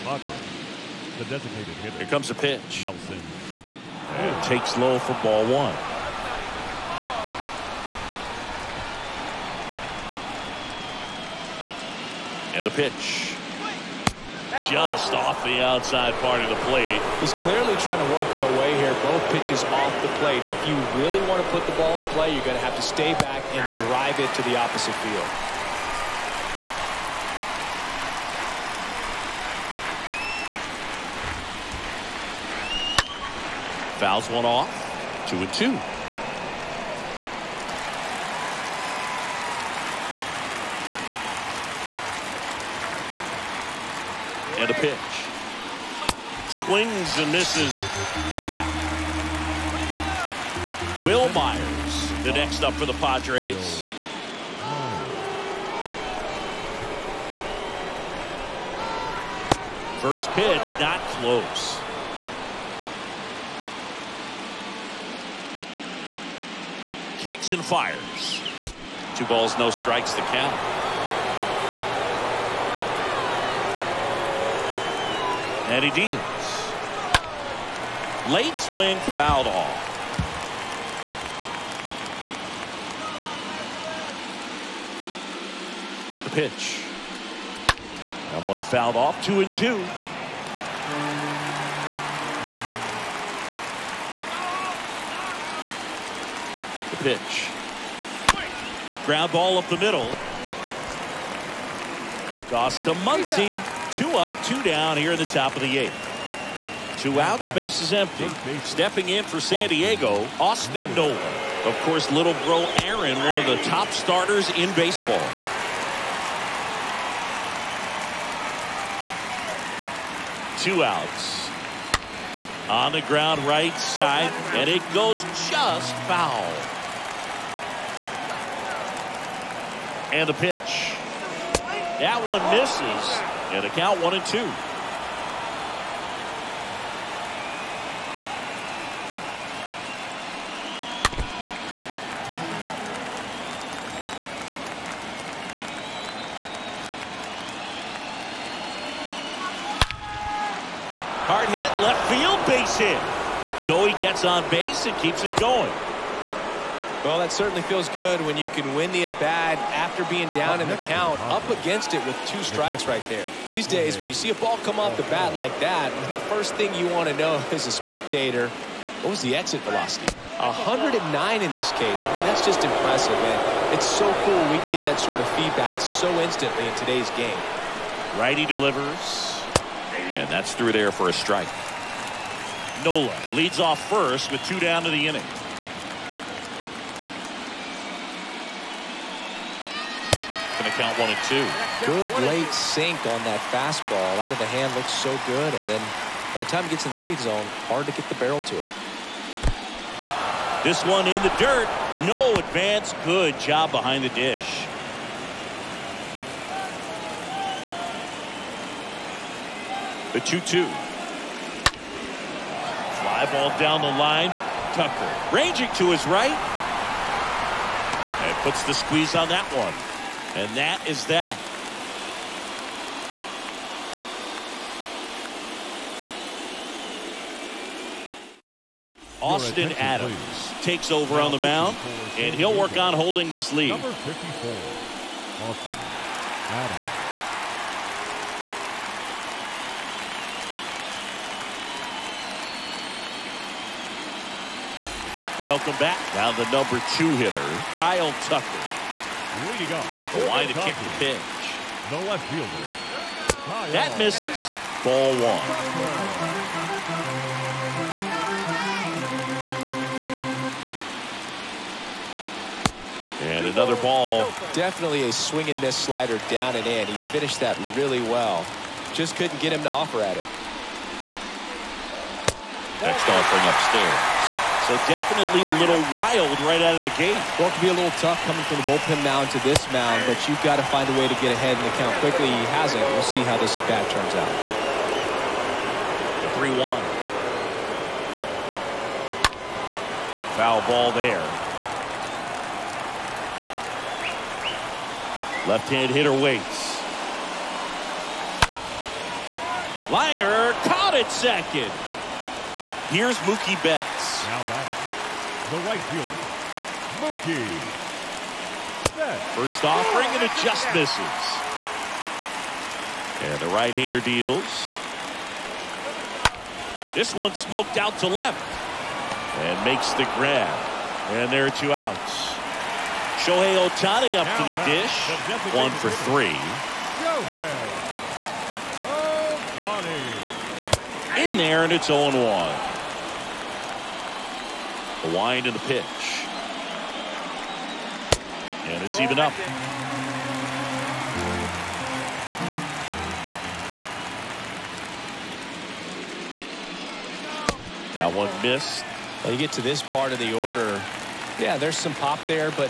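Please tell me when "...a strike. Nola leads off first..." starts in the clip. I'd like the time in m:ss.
3:01.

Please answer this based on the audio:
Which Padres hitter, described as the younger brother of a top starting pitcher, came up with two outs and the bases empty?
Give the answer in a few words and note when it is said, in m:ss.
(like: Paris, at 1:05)
Austin Nola, at 1:50.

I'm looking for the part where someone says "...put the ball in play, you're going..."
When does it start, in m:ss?
0:21.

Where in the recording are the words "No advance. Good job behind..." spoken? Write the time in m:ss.
3:22.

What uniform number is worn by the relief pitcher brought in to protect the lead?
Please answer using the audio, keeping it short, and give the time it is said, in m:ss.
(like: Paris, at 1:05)
54, at 3:53.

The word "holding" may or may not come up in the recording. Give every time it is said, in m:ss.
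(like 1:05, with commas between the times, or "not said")
3:52.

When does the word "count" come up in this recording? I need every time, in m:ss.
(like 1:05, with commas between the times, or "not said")
1:10, 2:13, 2:40, 3:10, 4:41.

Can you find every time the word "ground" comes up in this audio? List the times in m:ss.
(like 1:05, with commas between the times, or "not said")
1:39, 2:03.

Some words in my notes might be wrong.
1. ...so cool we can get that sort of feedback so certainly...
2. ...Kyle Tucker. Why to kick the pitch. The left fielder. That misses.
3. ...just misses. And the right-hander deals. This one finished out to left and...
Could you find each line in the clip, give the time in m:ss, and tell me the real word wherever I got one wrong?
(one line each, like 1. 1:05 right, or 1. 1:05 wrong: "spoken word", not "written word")
1. 2:53 wrong: "instantly", not "certainly"
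2. 4:07 right
3. 5:10 wrong: "smoked", not "finished".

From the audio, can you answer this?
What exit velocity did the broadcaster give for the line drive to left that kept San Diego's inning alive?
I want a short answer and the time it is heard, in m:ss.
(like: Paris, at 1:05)
109, at 2:50.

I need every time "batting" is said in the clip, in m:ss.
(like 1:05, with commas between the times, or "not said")
5:04.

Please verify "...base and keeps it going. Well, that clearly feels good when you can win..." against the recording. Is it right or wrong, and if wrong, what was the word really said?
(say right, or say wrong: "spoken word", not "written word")
wrong: "certainly", not "clearly".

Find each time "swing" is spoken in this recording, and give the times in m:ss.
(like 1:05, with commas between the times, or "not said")
0:46, 1:18, 4:25.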